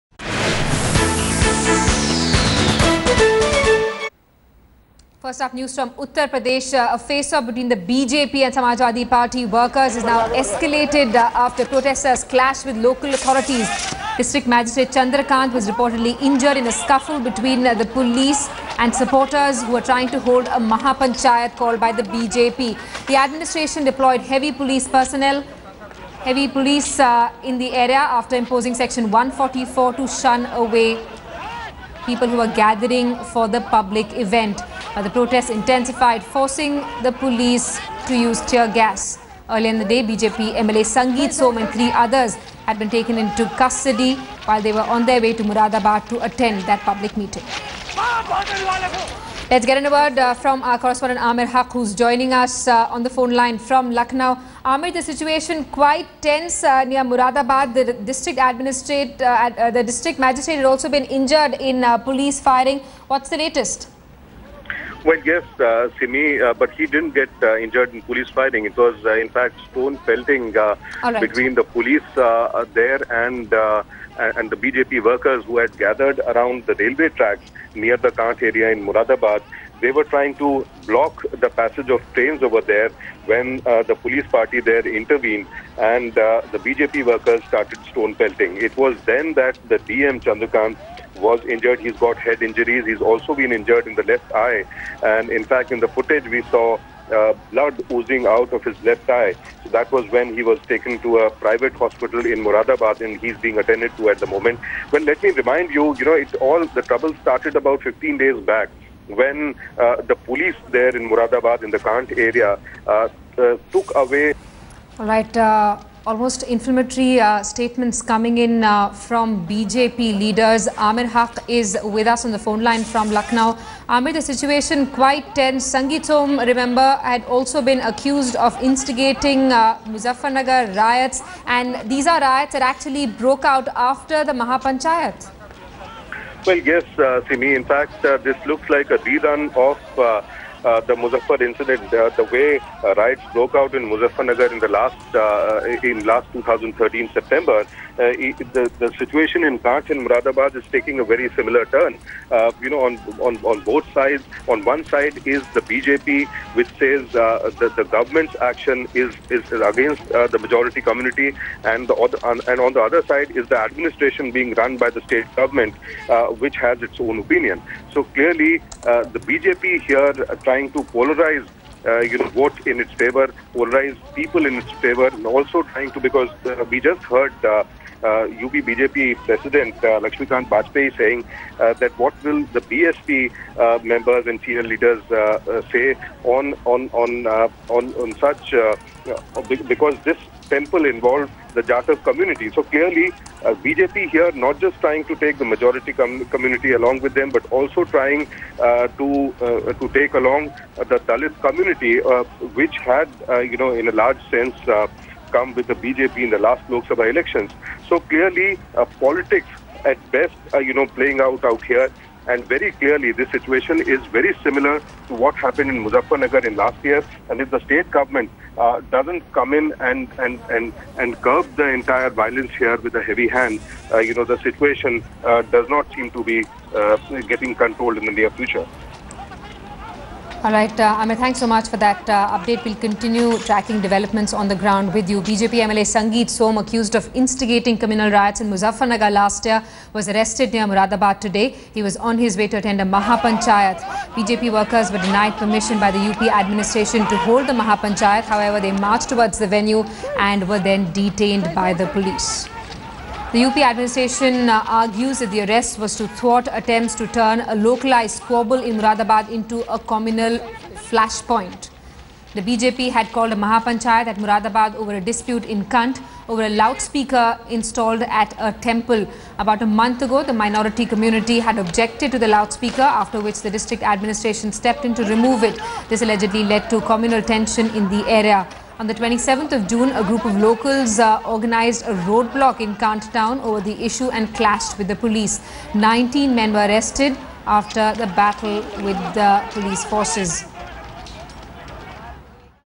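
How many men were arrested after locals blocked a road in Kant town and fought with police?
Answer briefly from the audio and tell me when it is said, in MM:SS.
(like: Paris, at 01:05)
19, at 04:45.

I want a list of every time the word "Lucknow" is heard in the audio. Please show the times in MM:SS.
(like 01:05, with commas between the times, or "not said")
00:53, 02:03.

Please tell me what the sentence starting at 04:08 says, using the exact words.
However, they marched towards the venue and were then detained by the police.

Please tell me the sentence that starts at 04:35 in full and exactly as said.
This allegedly led to communal tension in the area.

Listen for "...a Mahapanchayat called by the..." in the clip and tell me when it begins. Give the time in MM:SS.
00:20.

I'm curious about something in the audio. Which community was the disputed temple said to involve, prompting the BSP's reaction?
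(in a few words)
Jatav community.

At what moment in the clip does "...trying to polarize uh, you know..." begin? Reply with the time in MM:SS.
02:50.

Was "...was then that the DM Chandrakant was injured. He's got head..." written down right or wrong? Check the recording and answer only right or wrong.
right.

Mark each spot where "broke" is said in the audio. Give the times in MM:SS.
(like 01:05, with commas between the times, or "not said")
02:13, 02:23.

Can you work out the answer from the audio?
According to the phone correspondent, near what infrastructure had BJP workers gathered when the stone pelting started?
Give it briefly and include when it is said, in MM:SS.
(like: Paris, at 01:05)
railway tracks, at 01:16.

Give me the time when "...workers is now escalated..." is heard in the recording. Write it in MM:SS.
00:09.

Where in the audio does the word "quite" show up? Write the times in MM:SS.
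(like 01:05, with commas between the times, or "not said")
00:55, 02:04.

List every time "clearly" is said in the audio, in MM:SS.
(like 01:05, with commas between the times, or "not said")
02:48, 03:12, 03:28, 03:32.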